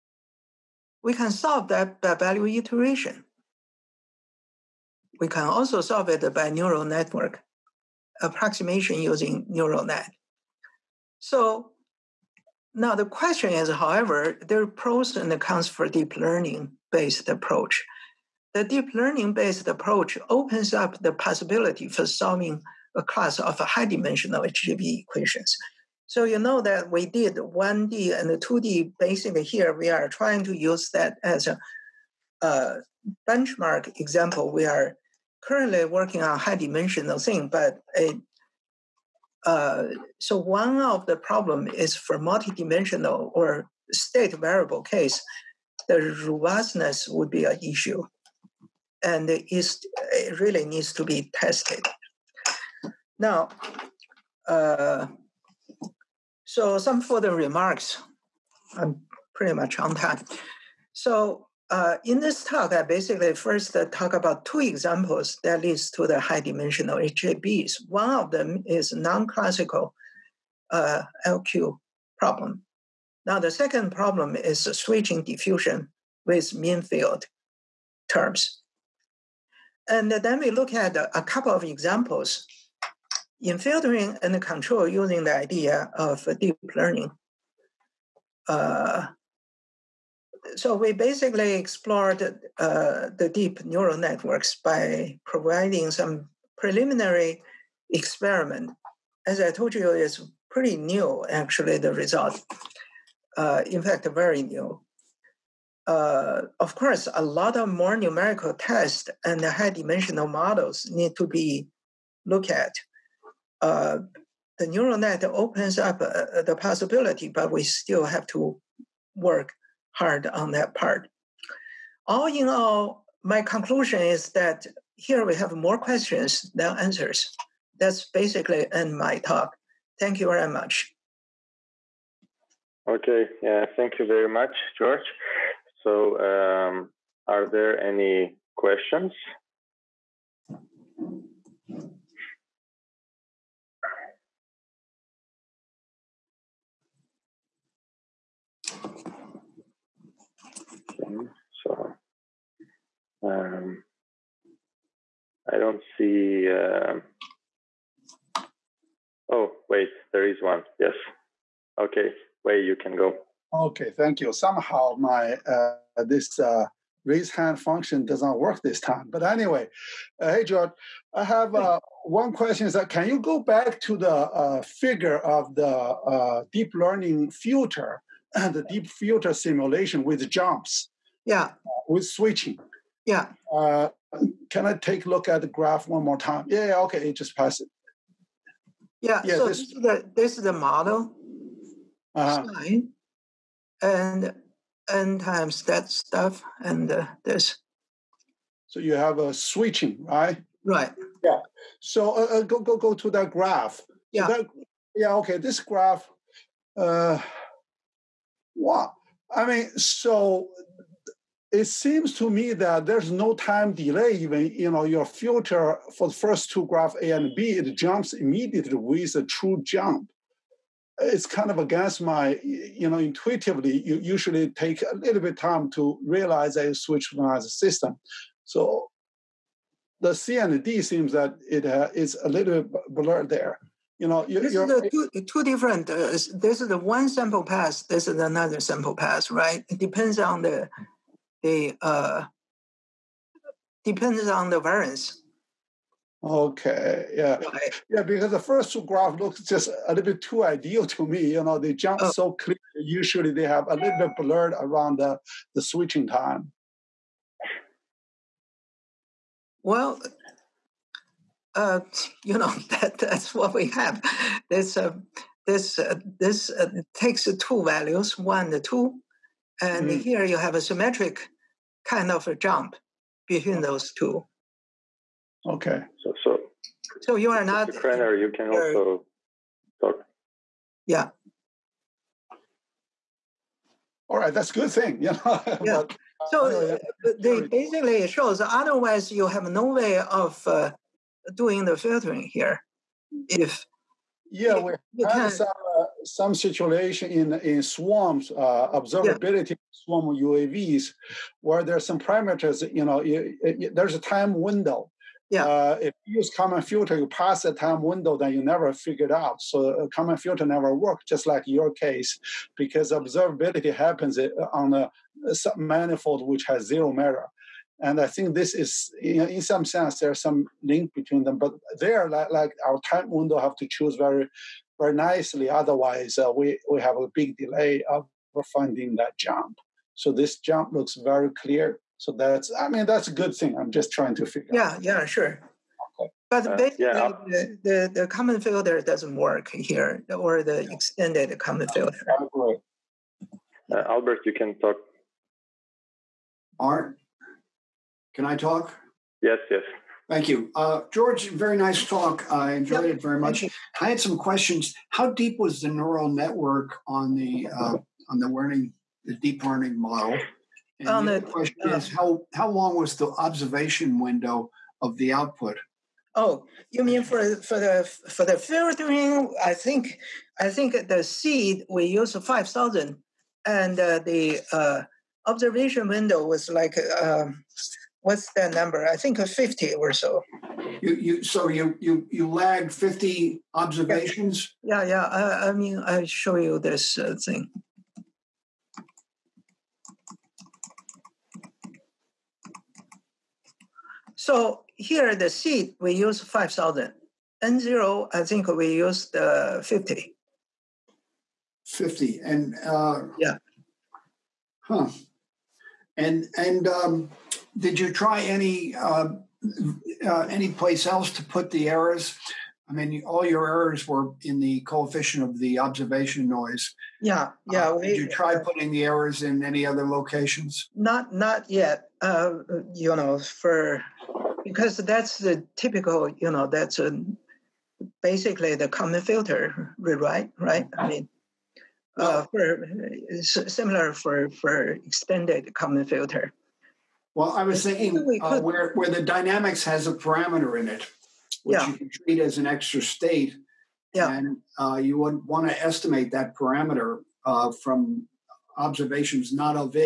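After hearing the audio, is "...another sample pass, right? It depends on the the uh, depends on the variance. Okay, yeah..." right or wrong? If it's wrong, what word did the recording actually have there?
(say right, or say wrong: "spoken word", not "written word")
right.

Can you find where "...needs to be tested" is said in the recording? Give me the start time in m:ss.
0:50.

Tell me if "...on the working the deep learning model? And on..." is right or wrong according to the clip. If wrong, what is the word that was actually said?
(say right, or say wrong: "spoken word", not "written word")
wrong: "learning", not "working".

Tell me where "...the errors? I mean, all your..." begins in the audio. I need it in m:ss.
6:51.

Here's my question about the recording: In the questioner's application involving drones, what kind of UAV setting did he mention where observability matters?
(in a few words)
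Swarm UAVs.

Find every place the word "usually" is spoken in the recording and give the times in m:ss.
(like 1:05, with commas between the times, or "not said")
3:43, 4:12.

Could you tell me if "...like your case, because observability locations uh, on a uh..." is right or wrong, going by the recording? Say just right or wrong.
wrong.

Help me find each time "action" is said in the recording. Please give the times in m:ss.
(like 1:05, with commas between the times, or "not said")
not said.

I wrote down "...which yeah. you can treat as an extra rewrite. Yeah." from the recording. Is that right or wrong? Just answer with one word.
wrong.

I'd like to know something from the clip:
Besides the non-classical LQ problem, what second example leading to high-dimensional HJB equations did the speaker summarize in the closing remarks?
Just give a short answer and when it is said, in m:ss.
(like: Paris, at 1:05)
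Switching diffusion with mean field terms, at 1:14.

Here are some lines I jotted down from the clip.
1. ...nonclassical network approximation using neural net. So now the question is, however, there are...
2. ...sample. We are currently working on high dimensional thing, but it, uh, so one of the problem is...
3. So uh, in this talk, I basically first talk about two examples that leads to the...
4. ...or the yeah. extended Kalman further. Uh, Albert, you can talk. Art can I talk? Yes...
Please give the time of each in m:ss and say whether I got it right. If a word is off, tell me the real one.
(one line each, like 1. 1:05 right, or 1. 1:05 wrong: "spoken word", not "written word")
1. 0:06 wrong: "neural", not "nonclassical"
2. 0:34 wrong: "example", not "sample"
3. 1:00 right
4. 5:40 wrong: "filter", not "further".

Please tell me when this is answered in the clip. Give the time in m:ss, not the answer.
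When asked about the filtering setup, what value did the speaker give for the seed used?
6:12.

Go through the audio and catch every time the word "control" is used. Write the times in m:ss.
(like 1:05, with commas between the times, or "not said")
1:24.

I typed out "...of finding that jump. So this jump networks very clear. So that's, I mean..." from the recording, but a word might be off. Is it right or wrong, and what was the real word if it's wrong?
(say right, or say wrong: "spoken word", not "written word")
wrong: "looks", not "networks".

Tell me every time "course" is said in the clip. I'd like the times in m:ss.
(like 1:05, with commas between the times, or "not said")
1:46.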